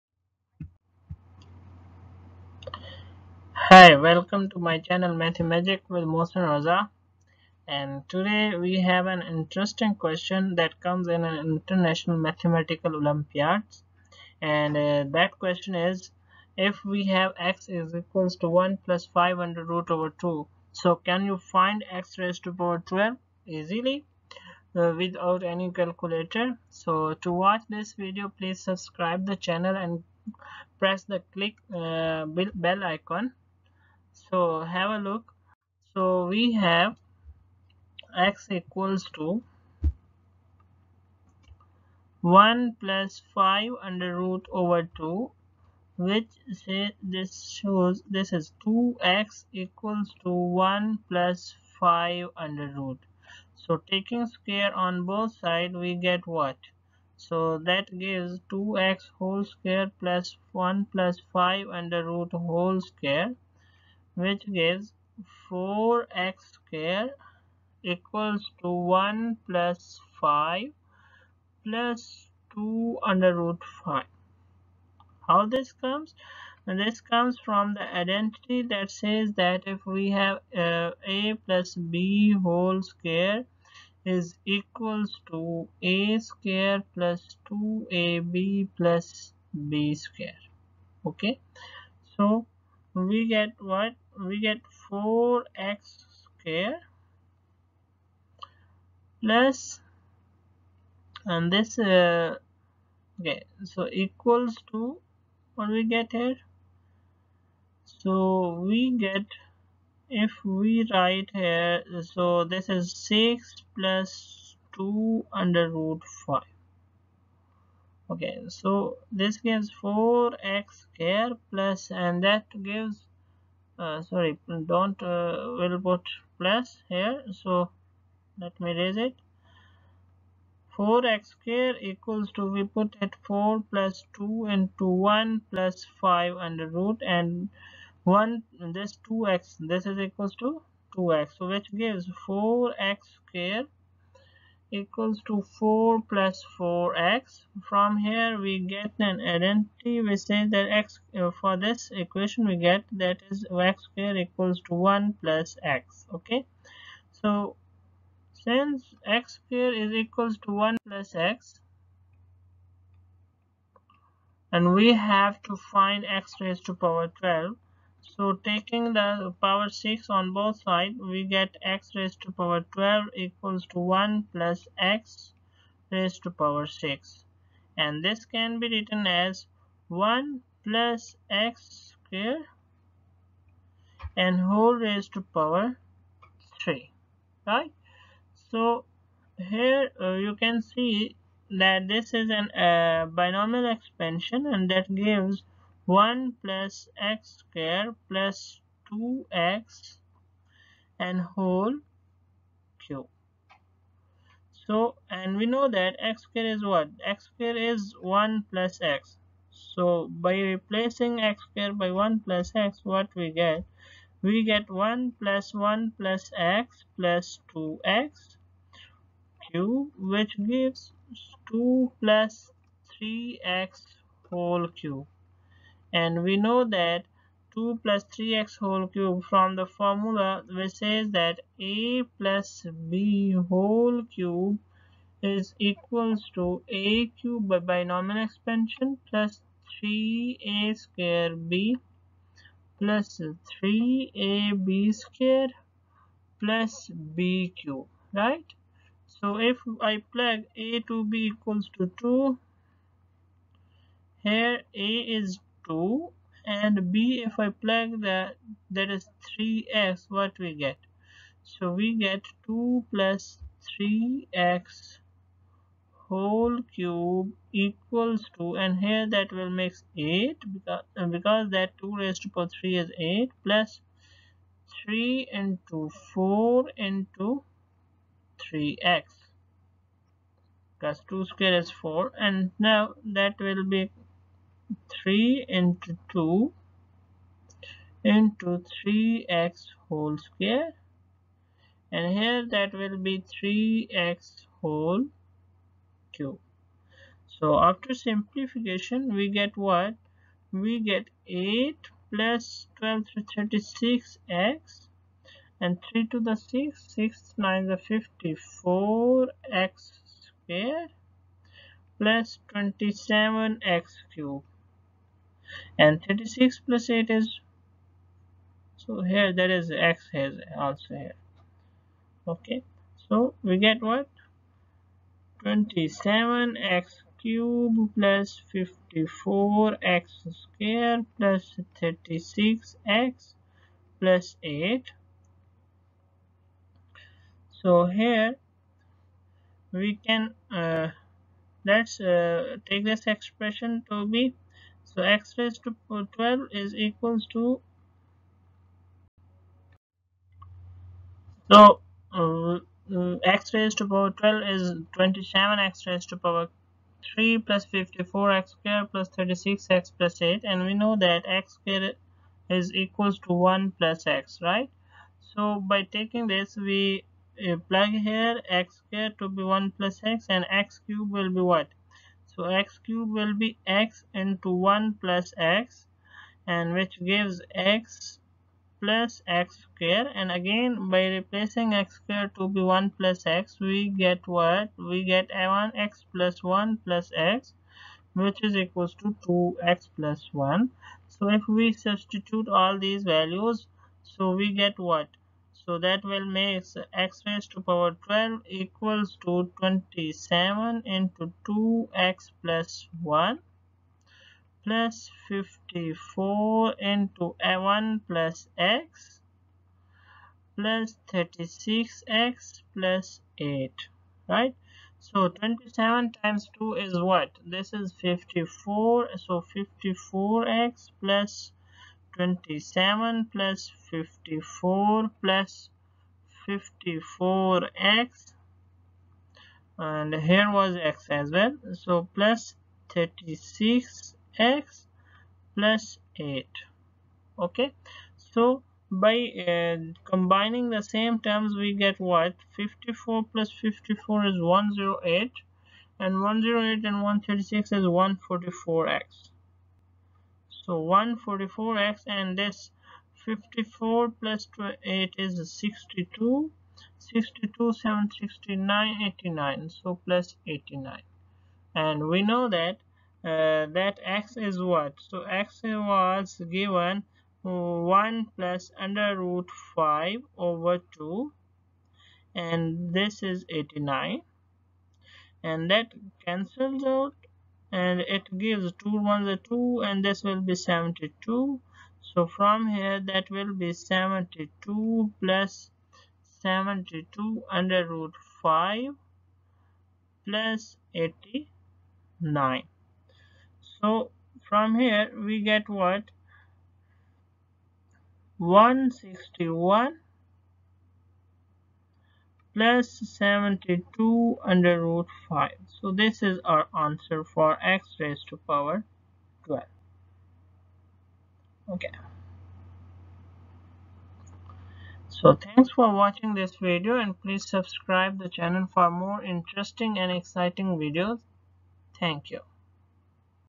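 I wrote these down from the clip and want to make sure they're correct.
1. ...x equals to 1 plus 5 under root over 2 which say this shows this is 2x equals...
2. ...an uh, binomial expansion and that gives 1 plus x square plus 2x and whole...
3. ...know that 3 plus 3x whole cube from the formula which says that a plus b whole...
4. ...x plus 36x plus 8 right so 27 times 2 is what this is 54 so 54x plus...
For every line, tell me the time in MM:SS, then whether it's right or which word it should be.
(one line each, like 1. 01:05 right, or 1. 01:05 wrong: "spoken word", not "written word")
1. 00:38 right
2. 03:12 right
3. 03:46 wrong: "2", not "3"
4. 06:48 right.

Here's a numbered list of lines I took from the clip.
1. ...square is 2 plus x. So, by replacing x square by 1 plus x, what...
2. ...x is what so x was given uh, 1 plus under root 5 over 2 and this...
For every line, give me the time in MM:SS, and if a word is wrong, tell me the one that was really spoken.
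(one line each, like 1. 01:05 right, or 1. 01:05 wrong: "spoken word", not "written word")
1. 03:27 wrong: "1", not "2"
2. 07:44 right.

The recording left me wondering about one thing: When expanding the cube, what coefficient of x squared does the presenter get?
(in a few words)
54.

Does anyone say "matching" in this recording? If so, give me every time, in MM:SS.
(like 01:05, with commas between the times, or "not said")
not said.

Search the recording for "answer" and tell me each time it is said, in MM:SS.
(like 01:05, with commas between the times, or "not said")
08:26.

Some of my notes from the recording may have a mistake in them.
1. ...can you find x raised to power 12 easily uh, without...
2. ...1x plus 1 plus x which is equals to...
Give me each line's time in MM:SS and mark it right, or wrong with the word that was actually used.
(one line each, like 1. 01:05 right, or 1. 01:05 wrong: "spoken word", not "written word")
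1. 00:20 right
2. 06:25 right.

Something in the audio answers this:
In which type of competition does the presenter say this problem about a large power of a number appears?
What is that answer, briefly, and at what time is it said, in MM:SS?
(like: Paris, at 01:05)
International mathematical olympiads, at 00:11.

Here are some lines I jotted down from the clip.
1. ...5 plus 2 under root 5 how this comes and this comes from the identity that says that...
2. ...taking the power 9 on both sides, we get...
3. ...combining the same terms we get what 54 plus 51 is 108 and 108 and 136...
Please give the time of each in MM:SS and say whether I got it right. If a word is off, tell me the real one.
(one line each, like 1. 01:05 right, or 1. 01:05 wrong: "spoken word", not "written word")
1. 01:10 right
2. 02:48 wrong: "6", not "9"
3. 07:20 wrong: "54", not "51".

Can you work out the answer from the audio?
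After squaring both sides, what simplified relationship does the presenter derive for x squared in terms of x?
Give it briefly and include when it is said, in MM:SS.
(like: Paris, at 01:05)
1 plus x, at 02:33.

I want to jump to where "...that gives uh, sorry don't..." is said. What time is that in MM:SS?
02:02.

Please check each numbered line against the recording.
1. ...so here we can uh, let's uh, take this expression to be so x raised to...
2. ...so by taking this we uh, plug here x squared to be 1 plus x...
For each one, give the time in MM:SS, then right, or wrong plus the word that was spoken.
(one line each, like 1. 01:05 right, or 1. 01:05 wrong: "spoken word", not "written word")
1. 05:37 right
2. 06:05 right.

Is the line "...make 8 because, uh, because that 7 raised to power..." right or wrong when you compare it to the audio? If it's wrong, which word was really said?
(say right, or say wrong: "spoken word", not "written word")
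wrong: "2", not "7".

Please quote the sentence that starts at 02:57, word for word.
And this can be written as 1 plus x square and whole raised to power 3.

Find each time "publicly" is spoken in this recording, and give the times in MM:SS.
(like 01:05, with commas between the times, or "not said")
not said.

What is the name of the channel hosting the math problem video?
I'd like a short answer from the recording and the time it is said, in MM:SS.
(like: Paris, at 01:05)
Mathemagic, at 00:05.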